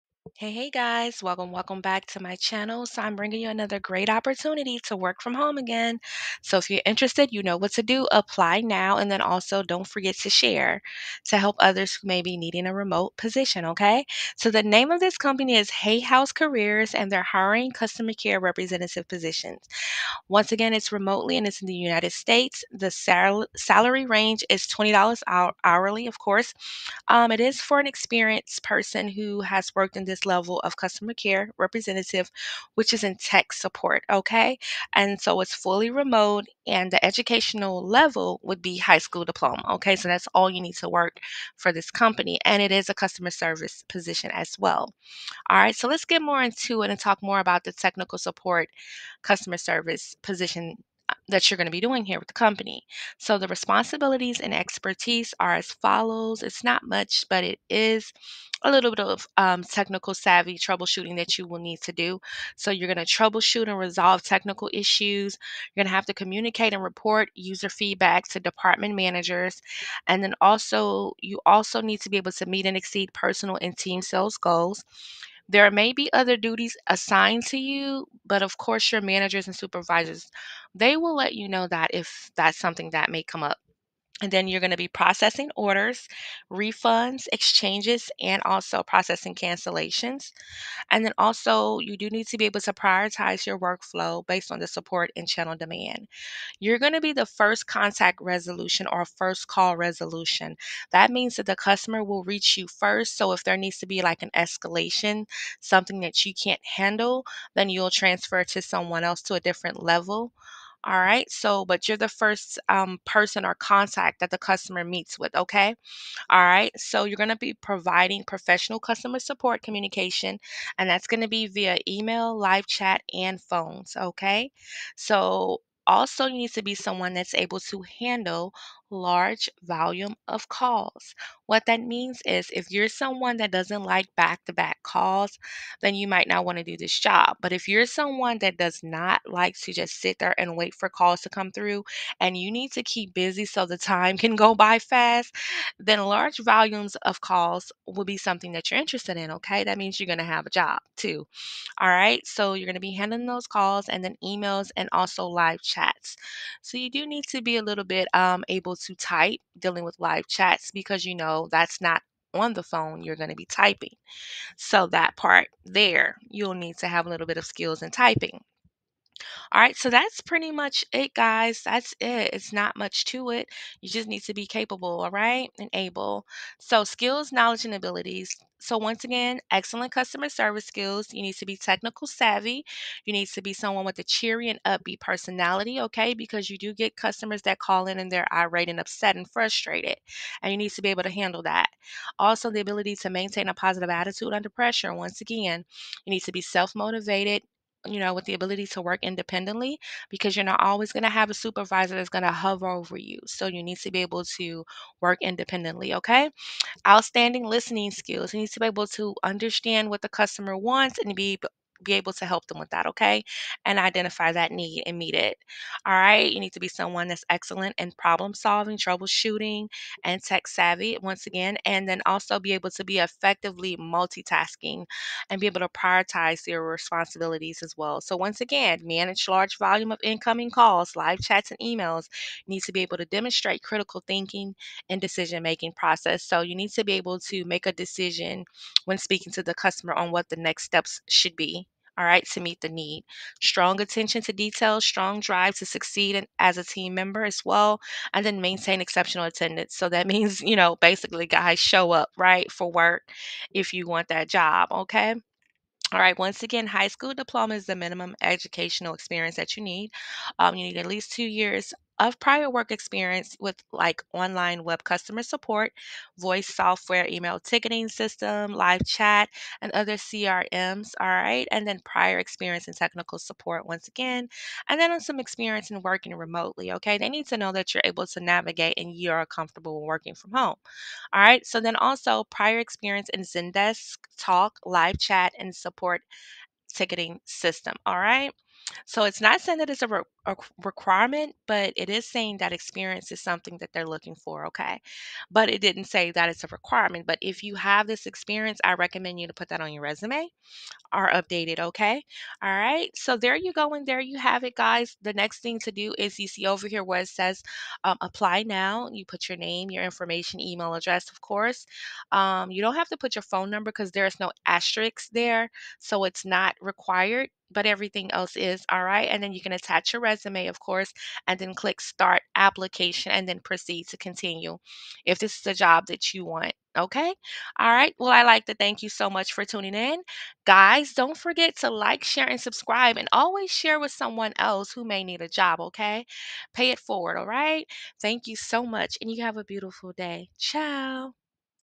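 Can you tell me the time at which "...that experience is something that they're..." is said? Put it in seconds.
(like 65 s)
292 s.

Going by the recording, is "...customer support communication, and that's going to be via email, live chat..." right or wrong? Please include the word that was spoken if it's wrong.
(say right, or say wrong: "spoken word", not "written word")
right.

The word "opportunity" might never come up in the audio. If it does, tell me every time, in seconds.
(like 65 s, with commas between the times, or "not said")
4 s.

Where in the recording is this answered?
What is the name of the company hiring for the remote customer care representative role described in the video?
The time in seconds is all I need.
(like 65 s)
15 s.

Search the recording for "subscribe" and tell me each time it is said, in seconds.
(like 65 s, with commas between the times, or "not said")
332 s.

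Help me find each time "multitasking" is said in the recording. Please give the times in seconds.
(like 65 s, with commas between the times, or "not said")
223 s.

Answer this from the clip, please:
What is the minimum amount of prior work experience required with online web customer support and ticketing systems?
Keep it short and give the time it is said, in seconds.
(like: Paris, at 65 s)
2 years, at 261 s.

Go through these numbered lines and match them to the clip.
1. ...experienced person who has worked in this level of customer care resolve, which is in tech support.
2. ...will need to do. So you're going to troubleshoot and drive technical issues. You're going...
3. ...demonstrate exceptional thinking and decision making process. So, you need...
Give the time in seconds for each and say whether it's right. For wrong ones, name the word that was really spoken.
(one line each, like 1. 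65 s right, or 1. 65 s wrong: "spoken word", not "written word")
1. 27 s wrong: "representative", not "resolve"
2. 61 s wrong: "resolve", not "drive"
3. 233 s wrong: "critical", not "exceptional".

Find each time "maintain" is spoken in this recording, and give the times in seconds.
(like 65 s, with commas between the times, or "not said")
193 s, 248 s.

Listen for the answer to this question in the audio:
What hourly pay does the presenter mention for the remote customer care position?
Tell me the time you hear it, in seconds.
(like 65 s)
24 s.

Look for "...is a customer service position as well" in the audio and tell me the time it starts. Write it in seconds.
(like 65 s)
42 s.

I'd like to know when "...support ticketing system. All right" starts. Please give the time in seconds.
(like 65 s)
285 s.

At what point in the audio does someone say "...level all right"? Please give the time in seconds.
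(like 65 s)
109 s.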